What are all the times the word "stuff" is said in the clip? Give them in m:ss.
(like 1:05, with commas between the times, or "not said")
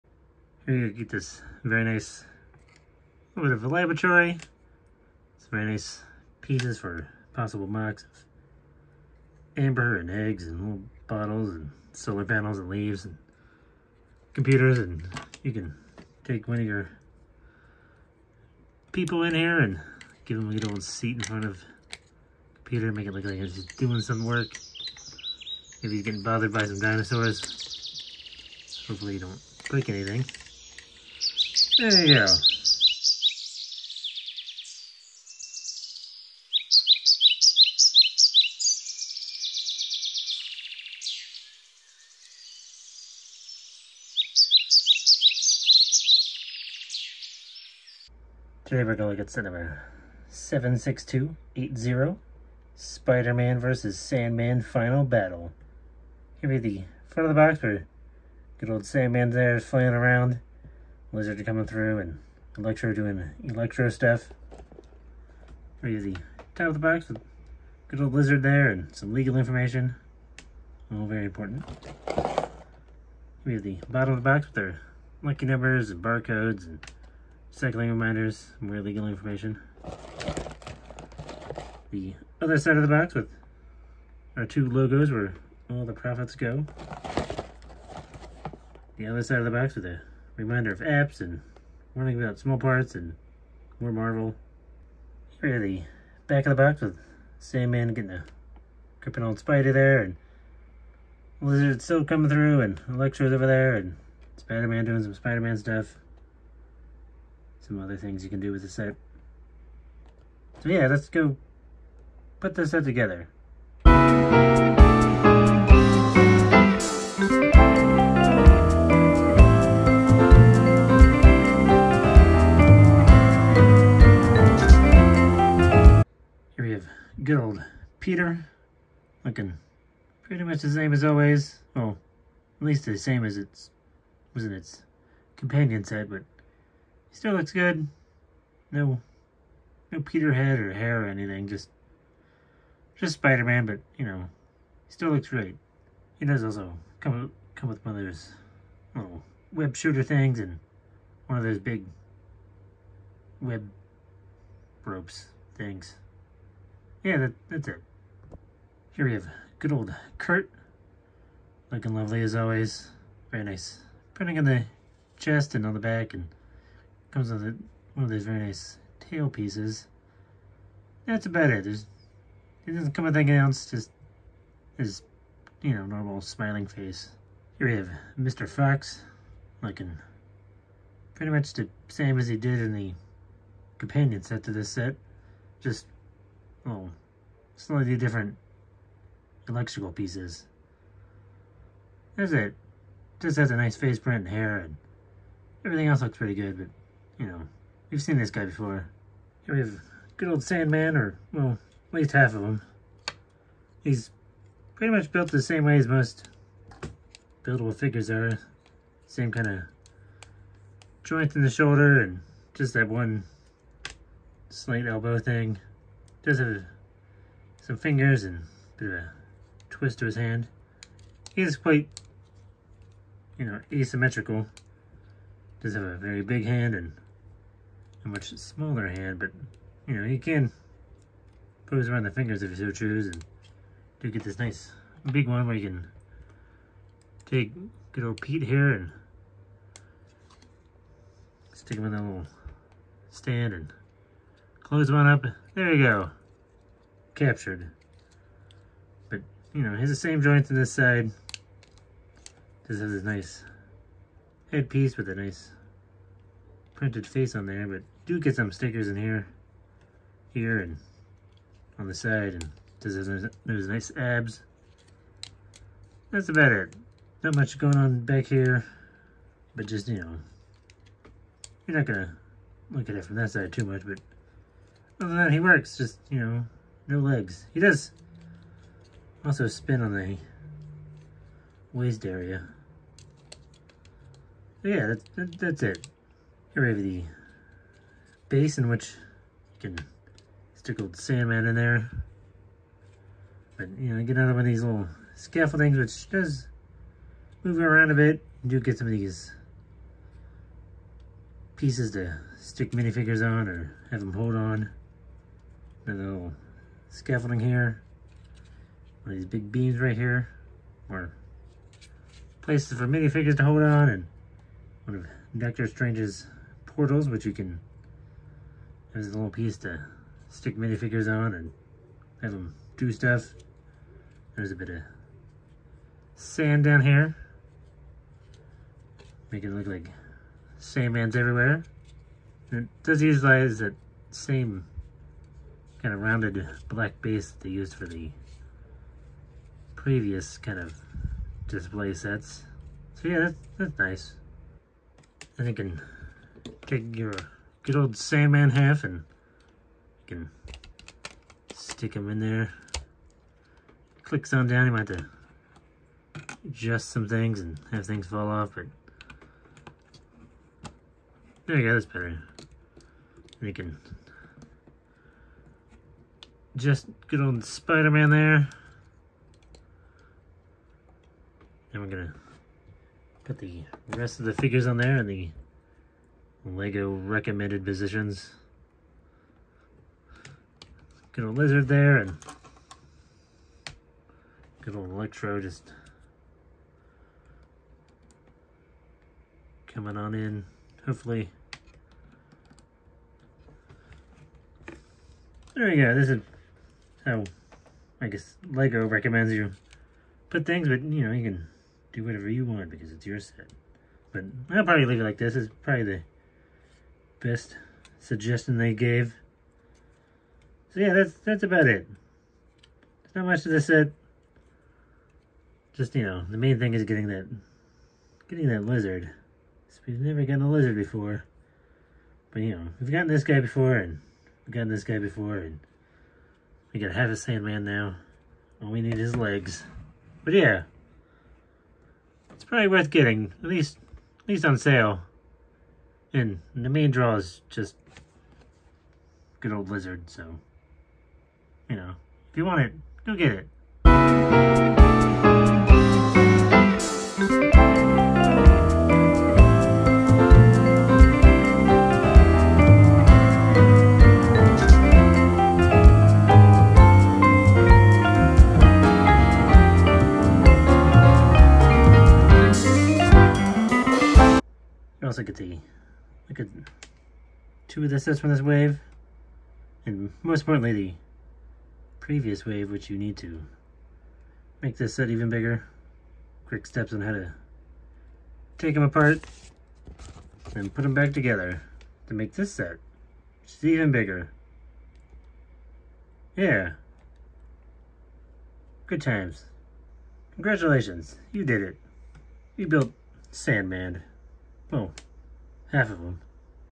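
1:03, 1:45, 5:22.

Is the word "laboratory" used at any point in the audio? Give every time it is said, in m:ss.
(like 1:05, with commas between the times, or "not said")
0:03.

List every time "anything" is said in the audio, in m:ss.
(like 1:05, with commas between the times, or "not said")
0:29, 2:21, 2:53.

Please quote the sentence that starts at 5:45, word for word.
Then you can take your good old Sandman half and you can stick him in there.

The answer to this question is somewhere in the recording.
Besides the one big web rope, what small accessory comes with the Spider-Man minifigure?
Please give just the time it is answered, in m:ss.
2:29.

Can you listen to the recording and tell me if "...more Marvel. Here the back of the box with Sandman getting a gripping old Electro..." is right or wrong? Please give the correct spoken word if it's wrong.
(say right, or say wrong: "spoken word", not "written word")
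wrong: "Spider", not "Electro".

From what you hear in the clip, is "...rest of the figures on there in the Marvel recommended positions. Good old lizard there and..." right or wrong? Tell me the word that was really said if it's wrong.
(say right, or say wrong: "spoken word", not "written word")
wrong: "Lego", not "Marvel".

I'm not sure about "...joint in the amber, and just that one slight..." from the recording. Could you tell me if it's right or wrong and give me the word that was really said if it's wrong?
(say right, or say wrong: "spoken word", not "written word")
wrong: "shoulder", not "amber".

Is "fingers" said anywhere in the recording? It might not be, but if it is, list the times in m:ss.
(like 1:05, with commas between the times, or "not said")
3:37, 3:52.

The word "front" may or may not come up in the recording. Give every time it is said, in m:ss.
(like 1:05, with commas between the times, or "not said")
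0:21, 0:57.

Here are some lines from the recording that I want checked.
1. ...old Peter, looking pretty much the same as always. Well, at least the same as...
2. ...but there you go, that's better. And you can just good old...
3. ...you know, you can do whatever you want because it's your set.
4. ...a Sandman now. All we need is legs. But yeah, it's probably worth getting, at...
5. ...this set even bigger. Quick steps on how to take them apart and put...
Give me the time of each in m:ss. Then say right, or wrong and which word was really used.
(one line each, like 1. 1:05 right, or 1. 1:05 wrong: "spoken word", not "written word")
1. 2:07 right
2. 5:58 right
3. 6:40 right
4. 7:07 right
5. 7:54 right.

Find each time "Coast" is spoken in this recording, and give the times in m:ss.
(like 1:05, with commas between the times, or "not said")
not said.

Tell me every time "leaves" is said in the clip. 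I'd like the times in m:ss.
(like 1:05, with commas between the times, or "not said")
0:12, 6:44.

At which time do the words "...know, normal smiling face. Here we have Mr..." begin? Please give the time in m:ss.
2:55.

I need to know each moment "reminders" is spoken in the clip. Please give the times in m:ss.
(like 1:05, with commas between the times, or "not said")
1:17, 1:30.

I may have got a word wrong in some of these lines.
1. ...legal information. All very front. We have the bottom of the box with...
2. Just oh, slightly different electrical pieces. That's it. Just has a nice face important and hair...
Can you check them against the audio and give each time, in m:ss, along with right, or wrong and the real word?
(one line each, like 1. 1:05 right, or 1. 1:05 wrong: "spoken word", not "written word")
1. 1:09 wrong: "important", not "front"
2. 3:05 wrong: "print", not "important".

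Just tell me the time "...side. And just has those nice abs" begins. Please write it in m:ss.
4:21.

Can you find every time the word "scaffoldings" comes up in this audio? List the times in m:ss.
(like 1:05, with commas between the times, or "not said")
4:55, 5:06.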